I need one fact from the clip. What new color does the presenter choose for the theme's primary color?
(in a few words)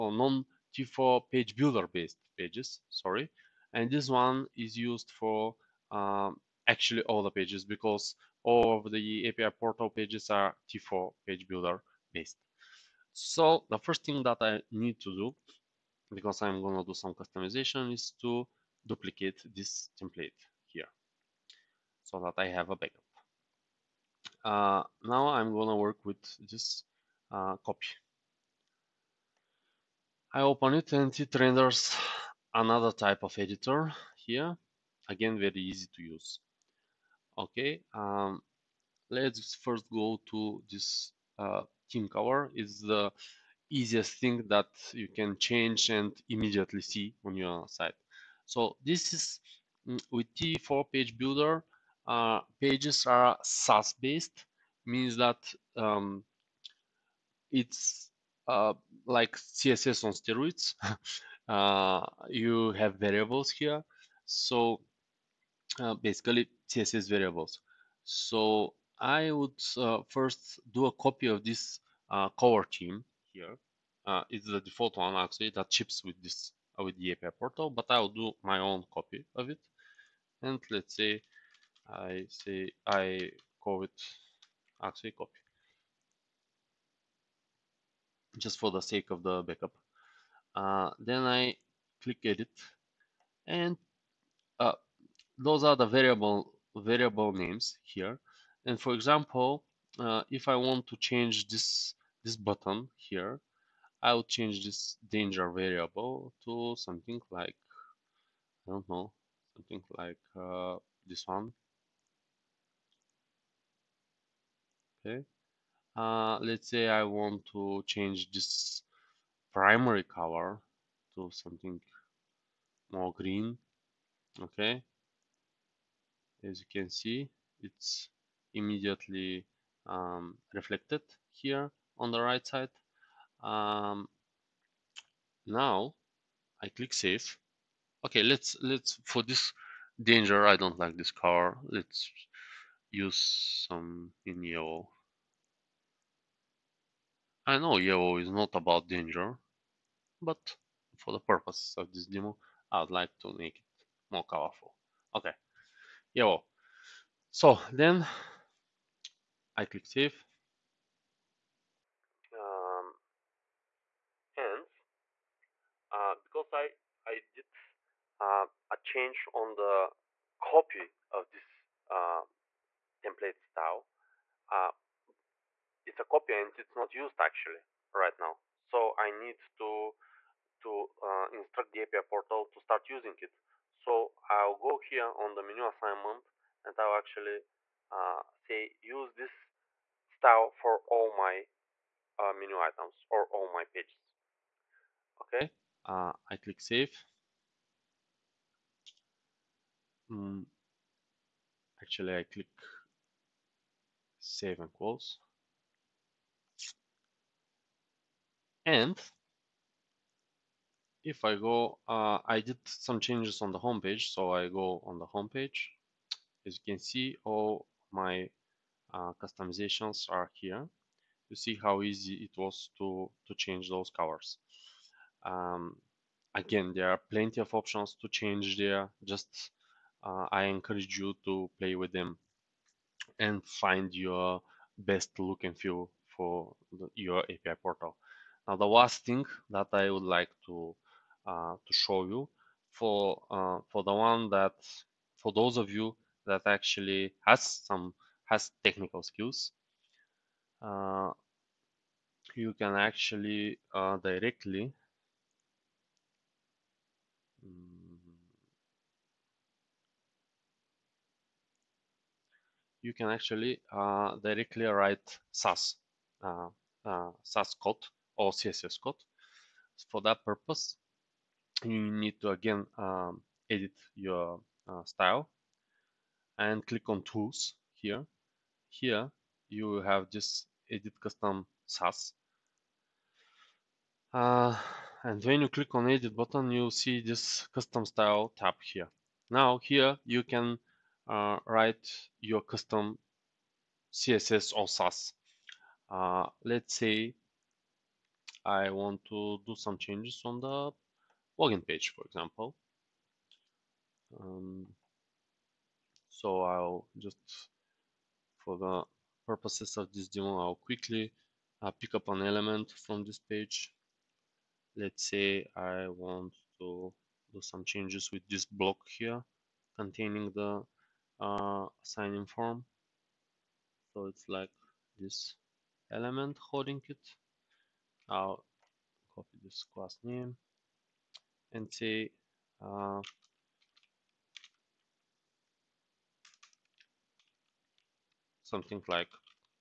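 green.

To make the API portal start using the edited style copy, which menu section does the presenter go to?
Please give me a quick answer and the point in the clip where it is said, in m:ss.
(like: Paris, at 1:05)
menu assignment, at 3:05.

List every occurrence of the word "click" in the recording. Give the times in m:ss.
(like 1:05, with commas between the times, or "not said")
1:32, 2:16, 2:39, 3:16, 3:22, 4:36, 4:45.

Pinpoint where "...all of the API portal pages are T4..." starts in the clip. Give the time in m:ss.
0:08.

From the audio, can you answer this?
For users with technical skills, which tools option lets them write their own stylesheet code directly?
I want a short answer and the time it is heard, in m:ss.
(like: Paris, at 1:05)
edit custom SASS, at 4:40.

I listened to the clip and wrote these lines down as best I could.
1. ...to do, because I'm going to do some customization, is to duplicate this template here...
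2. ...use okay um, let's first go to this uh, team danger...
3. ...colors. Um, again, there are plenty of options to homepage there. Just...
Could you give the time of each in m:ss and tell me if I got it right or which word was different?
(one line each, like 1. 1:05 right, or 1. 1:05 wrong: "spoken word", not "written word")
1. 0:14 right
2. 0:36 wrong: "cover", not "danger"
3. 3:43 wrong: "change", not "homepage".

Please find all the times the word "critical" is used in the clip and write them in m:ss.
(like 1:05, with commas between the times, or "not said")
not said.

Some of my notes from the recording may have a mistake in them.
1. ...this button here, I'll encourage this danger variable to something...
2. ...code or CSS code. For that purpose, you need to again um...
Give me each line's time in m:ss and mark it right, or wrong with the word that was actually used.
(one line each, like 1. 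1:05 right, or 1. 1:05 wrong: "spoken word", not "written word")
1. 1:42 wrong: "change", not "encourage"
2. 4:27 right.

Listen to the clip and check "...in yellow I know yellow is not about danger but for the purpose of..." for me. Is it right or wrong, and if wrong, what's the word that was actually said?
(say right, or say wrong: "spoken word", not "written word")
right.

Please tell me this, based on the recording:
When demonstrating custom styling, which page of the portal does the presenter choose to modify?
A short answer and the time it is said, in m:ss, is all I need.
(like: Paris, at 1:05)
login page, at 5:01.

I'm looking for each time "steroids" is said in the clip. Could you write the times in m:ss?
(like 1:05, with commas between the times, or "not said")
1:00.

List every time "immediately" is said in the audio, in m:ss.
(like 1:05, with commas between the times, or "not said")
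0:46, 2:08.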